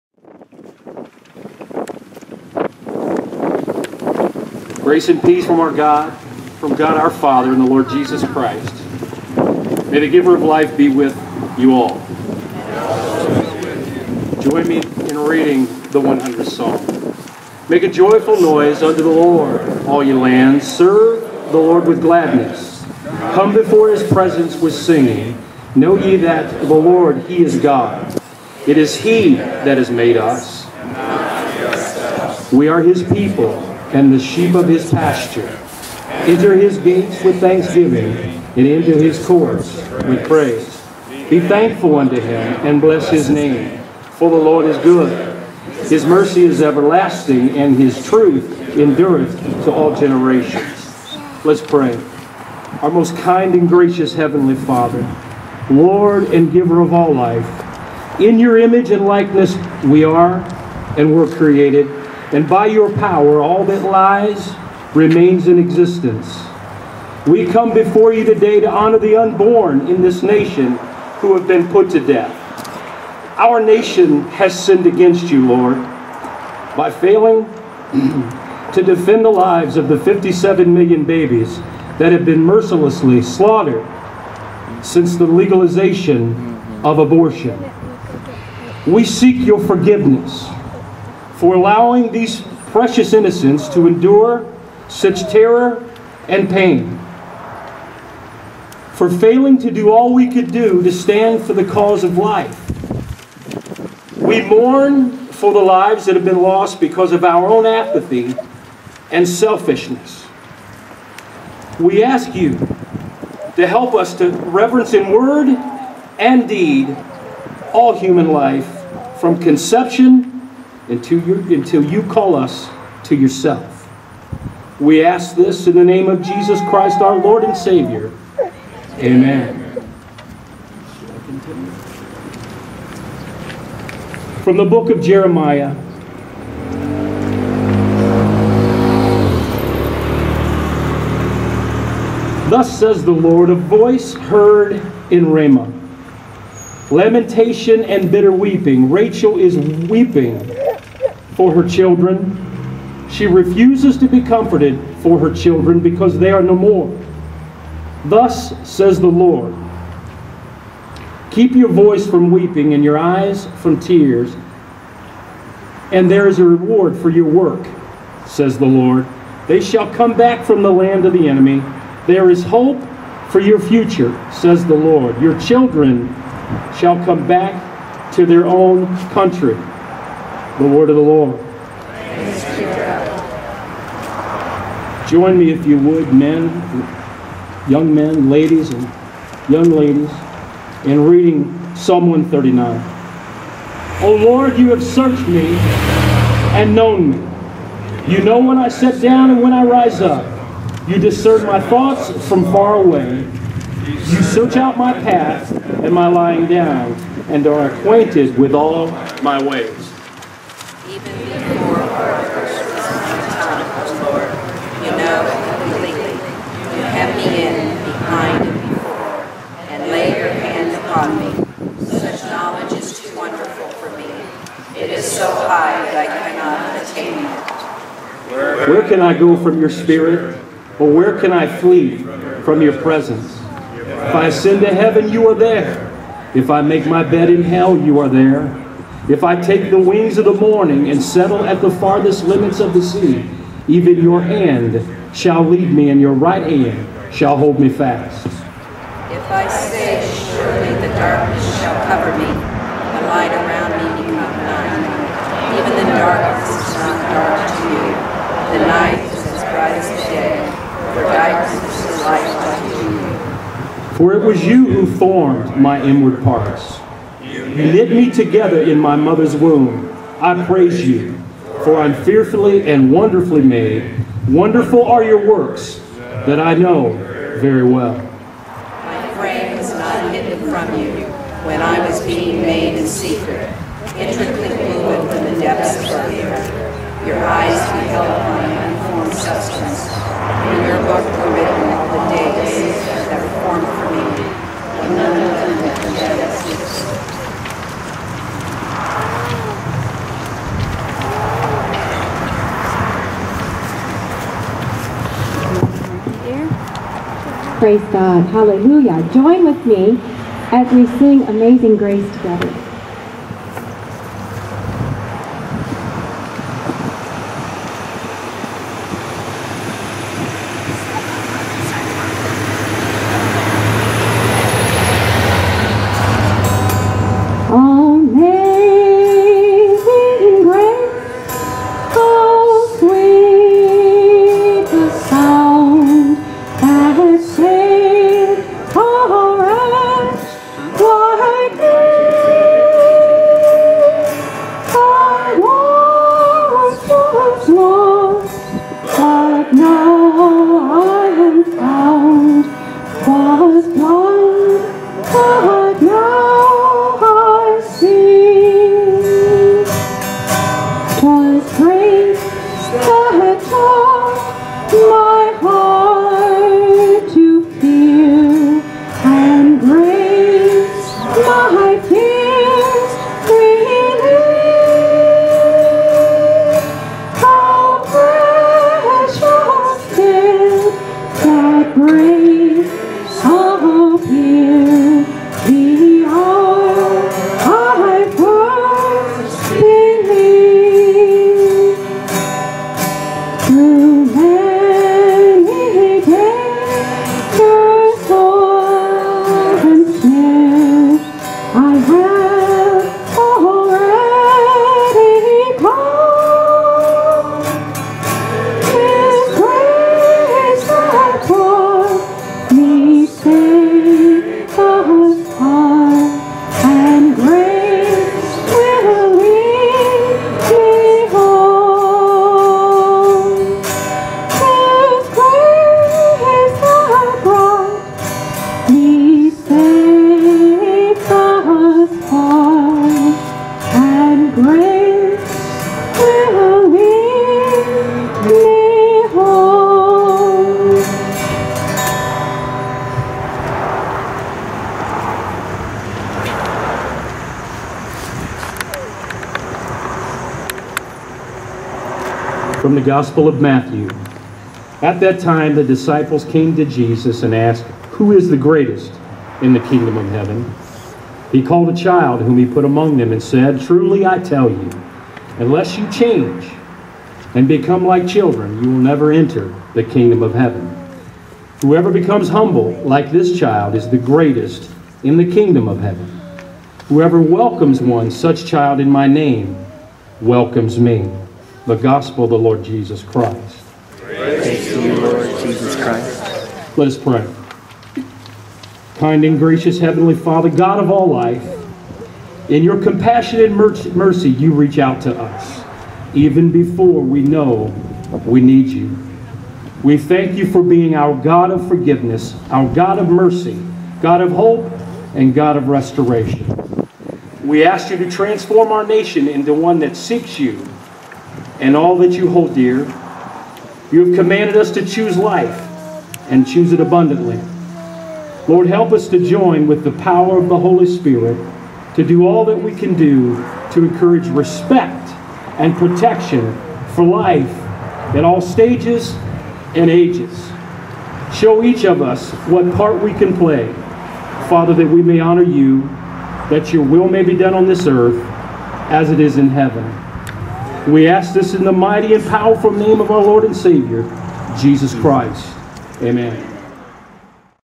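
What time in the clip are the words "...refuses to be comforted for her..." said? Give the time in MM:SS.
02:33.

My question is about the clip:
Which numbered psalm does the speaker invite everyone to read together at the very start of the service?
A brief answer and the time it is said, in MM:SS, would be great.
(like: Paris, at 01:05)
100th Psalm, at 00:16.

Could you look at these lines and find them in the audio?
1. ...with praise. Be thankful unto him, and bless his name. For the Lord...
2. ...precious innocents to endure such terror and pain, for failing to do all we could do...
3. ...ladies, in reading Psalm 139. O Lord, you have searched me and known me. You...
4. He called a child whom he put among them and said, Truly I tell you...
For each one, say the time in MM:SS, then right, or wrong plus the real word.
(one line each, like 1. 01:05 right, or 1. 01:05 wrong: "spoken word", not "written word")
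1. 00:40 right
2. 01:32 right
3. 03:09 right
4. 07:41 right.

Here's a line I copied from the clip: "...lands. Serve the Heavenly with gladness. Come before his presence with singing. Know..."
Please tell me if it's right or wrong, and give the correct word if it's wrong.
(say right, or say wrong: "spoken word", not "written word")
wrong: "Lord", not "Heavenly".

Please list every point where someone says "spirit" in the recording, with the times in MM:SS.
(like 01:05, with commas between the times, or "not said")
03:49, 08:40.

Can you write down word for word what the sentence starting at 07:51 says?
Whoever becomes humble like this child is the greatest in the kingdom of heaven.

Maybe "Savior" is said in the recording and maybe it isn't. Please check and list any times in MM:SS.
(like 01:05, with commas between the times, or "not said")
02:07, 09:03.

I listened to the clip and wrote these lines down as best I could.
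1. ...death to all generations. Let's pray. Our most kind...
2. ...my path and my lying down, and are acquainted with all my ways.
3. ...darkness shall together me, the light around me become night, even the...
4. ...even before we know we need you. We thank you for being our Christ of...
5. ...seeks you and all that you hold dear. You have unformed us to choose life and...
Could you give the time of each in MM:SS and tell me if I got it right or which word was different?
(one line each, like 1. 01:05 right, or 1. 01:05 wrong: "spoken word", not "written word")
1. 00:48 wrong: "endureth", not "death"
2. 03:24 right
3. 04:10 wrong: "cover", not "together"
4. 08:16 wrong: "God", not "Christ"
5. 08:29 wrong: "commanded", not "unformed".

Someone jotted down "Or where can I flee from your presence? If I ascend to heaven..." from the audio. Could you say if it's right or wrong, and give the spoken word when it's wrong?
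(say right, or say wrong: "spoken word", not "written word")
right.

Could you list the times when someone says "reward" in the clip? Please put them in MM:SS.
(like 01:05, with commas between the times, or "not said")
02:46.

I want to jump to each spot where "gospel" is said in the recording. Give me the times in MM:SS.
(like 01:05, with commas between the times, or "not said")
07:32, 08:01.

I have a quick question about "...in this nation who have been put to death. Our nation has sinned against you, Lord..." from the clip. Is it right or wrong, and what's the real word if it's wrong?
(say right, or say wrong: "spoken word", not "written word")
right.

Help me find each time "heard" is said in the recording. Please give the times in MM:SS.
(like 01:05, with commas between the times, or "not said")
02:24.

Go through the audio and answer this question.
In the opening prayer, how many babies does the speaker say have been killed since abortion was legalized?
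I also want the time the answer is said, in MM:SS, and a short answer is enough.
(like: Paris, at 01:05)
57 million, at 01:19.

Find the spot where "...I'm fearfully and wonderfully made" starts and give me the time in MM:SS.
04:31.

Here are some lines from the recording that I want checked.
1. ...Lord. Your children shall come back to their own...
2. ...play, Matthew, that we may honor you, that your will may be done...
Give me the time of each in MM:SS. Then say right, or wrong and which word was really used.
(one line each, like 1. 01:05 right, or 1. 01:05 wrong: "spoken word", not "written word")
1. 02:54 right
2. 08:53 wrong: "Father", not "Matthew".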